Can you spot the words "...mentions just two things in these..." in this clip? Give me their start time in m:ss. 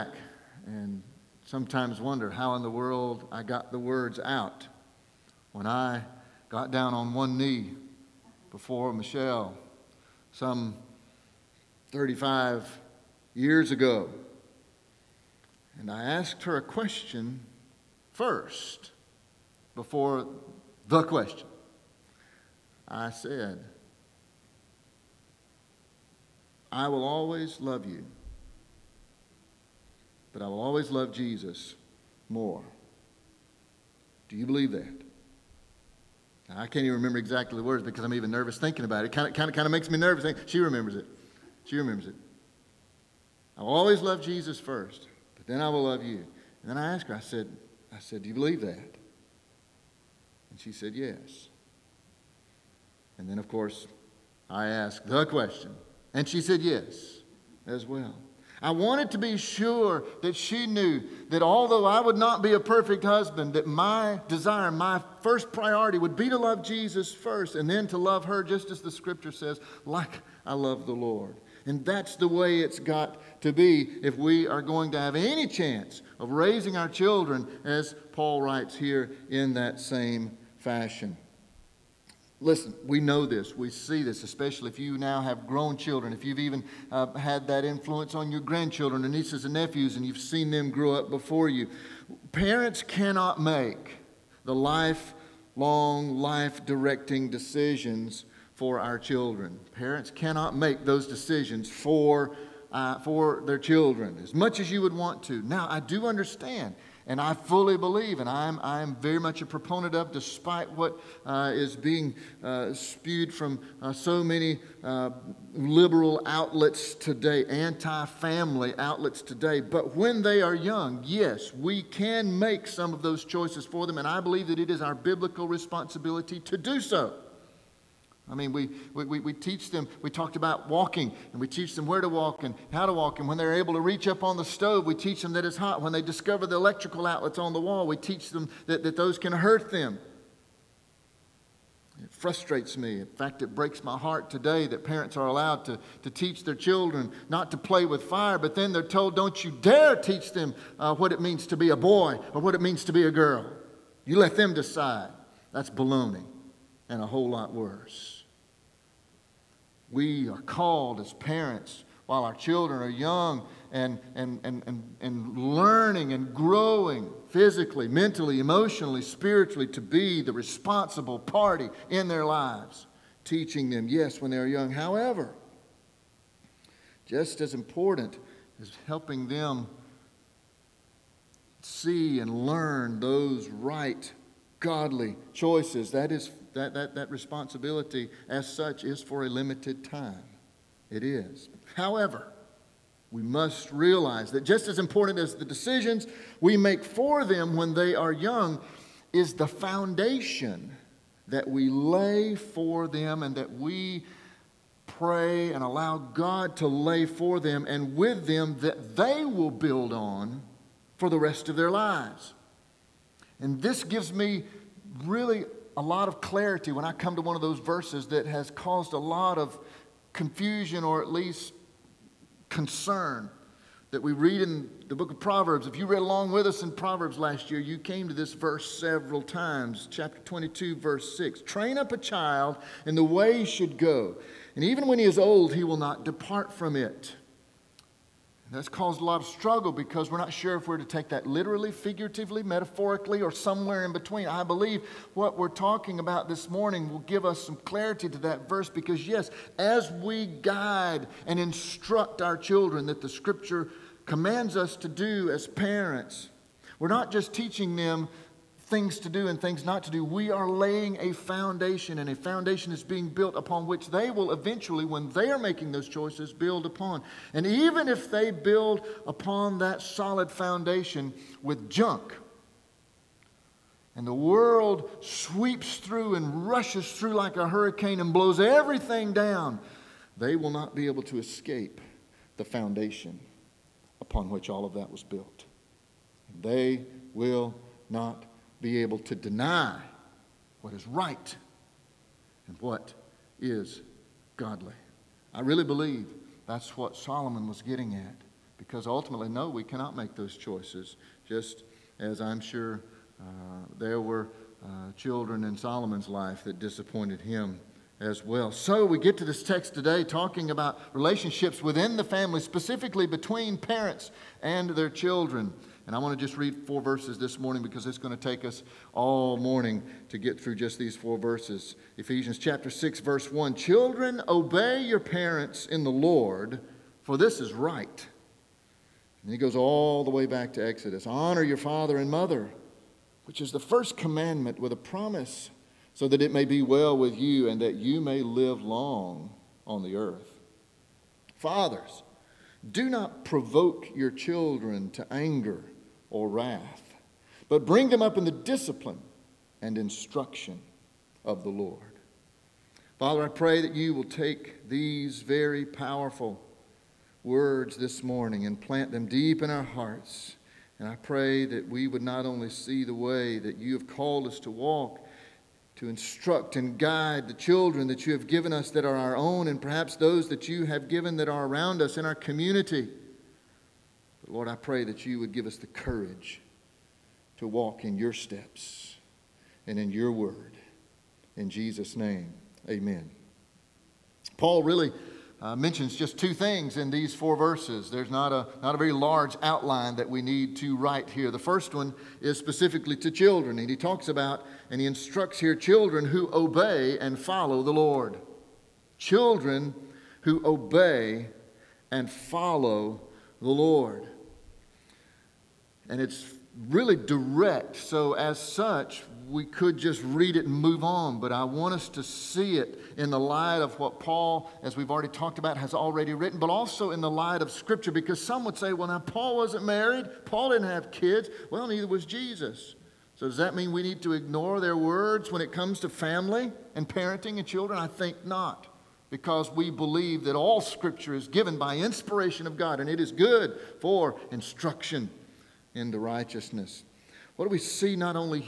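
6:25.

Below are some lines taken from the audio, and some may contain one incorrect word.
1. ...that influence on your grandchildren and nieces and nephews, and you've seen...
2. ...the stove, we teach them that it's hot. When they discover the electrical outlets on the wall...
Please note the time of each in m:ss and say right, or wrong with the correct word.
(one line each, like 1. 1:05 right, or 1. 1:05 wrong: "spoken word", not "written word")
1. 1:27 right
2. 2:14 right.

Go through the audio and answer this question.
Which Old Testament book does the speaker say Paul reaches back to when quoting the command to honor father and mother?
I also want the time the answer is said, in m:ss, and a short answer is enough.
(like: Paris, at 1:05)
Exodus, at 5:30.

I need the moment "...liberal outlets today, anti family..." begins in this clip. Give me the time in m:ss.
1:55.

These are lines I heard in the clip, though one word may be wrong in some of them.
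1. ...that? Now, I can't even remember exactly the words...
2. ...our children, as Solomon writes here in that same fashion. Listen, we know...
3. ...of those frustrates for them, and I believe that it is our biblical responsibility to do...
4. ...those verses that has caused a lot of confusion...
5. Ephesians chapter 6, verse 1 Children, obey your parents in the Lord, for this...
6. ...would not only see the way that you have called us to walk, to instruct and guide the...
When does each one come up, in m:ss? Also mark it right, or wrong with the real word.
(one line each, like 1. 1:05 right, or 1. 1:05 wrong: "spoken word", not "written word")
1. 0:34 right
2. 1:16 wrong: "Paul", not "Solomon"
3. 2:02 wrong: "choices", not "frustrates"
4. 3:37 right
5. 5:21 right
6. 6:01 right.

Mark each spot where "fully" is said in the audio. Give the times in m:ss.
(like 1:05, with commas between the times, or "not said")
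1:47.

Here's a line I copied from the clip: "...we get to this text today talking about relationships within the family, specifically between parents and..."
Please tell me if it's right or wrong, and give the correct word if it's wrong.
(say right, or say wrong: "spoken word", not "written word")
right.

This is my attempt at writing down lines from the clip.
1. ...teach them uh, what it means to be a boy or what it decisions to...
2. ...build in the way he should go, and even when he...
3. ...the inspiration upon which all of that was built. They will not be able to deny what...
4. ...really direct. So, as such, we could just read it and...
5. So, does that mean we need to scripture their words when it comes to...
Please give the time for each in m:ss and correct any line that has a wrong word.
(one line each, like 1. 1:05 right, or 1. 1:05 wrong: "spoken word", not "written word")
1. 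2:29 wrong: "means", not "decisions"
2. 3:51 wrong: "child", not "build"
3. 4:42 wrong: "foundation", not "inspiration"
4. 6:46 right
5. 7:03 wrong: "ignore", not "scripture".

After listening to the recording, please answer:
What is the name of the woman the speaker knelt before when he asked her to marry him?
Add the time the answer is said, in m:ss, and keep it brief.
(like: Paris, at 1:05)
Michelle, at 0:08.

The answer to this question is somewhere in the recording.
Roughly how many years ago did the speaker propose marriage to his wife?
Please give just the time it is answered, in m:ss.
0:11.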